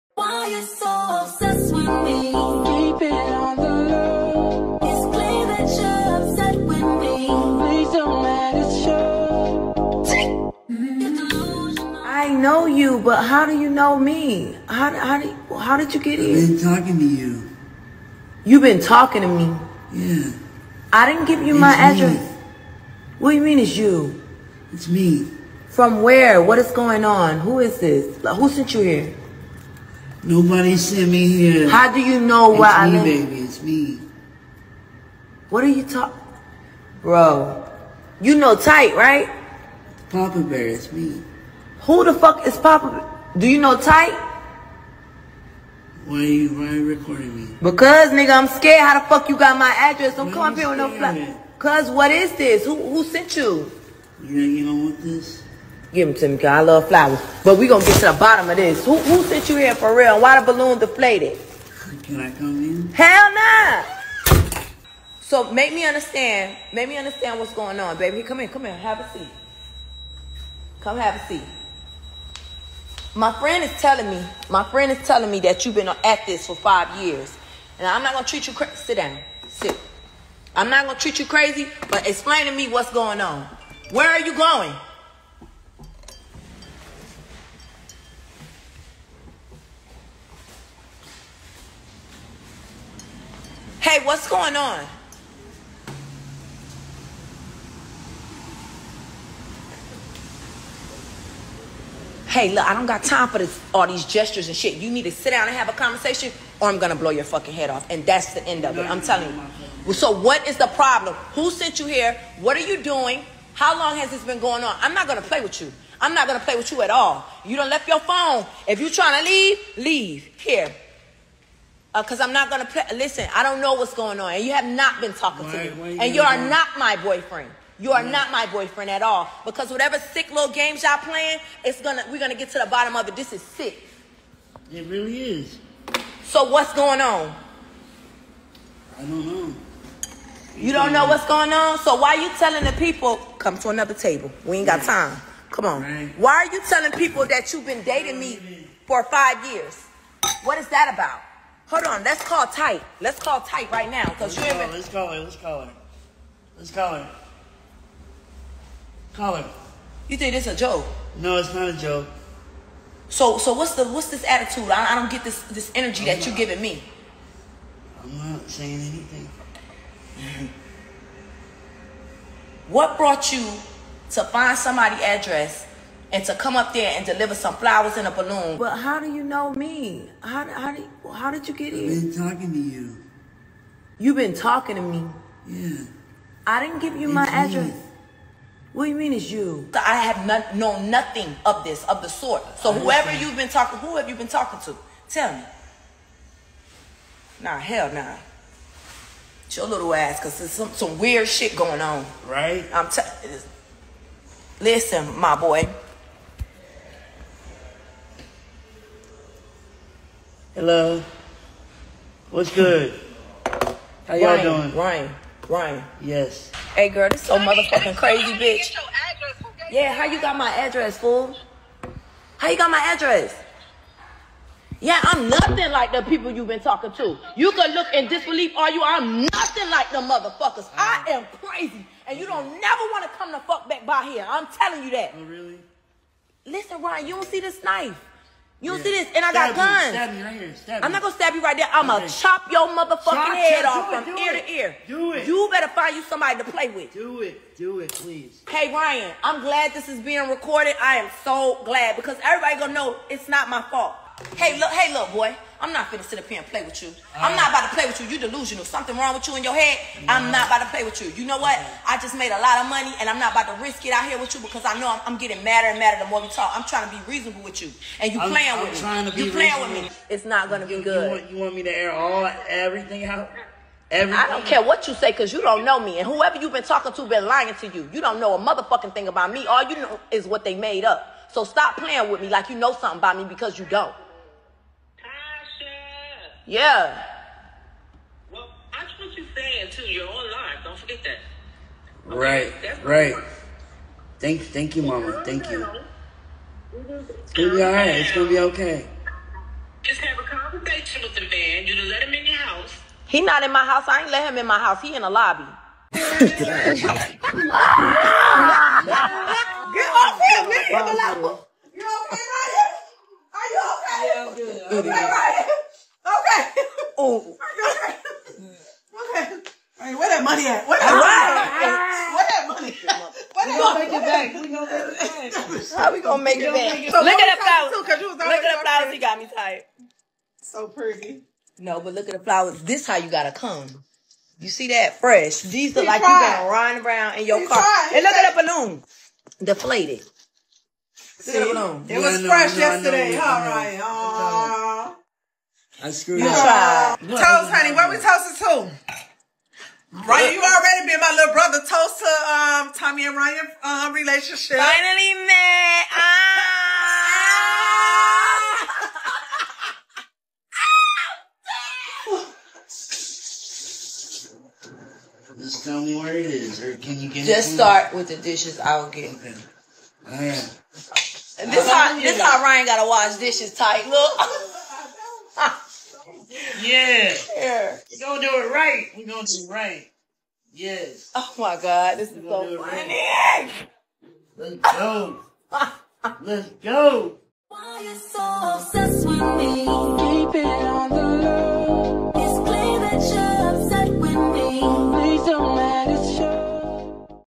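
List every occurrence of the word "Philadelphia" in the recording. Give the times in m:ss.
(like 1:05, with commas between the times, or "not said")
not said.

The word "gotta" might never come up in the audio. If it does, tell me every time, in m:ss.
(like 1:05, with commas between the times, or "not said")
5:33, 6:12.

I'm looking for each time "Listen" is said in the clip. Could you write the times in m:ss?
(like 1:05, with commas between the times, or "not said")
2:02, 3:24, 3:56.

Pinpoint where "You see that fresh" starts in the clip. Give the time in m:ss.
5:34.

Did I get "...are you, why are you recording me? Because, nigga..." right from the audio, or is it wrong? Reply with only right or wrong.
right.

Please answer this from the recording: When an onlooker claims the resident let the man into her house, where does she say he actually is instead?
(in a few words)
The lobby.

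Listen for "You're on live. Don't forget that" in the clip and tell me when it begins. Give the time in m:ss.
4:49.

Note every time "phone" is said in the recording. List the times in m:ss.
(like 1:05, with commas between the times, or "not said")
1:57.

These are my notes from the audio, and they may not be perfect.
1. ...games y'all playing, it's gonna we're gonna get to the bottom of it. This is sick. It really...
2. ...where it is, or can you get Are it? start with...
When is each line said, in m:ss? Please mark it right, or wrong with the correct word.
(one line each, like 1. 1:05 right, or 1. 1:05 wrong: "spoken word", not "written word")
1. 2:10 right
2. 6:06 wrong: "Just", not "Are".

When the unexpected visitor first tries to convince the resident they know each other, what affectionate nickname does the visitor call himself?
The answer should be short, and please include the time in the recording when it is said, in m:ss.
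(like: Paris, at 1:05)
Papa Bear, at 0:40.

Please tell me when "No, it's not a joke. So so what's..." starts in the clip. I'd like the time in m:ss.
2:41.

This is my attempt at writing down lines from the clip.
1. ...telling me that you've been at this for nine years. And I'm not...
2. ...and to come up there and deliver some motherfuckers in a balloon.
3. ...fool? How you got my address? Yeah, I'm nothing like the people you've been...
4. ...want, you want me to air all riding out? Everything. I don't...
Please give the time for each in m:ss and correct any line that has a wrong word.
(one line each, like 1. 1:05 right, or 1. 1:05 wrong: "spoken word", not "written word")
1. 1:15 wrong: "five", not "nine"
2. 2:56 wrong: "flowers", not "motherfuckers"
3. 3:40 right
4. 4:31 wrong: "everything", not "riding".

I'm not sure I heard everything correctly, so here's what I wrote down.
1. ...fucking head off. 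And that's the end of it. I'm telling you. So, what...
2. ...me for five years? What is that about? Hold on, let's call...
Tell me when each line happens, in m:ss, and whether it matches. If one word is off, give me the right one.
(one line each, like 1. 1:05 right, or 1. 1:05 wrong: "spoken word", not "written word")
1. 1:47 right
2. 2:28 right.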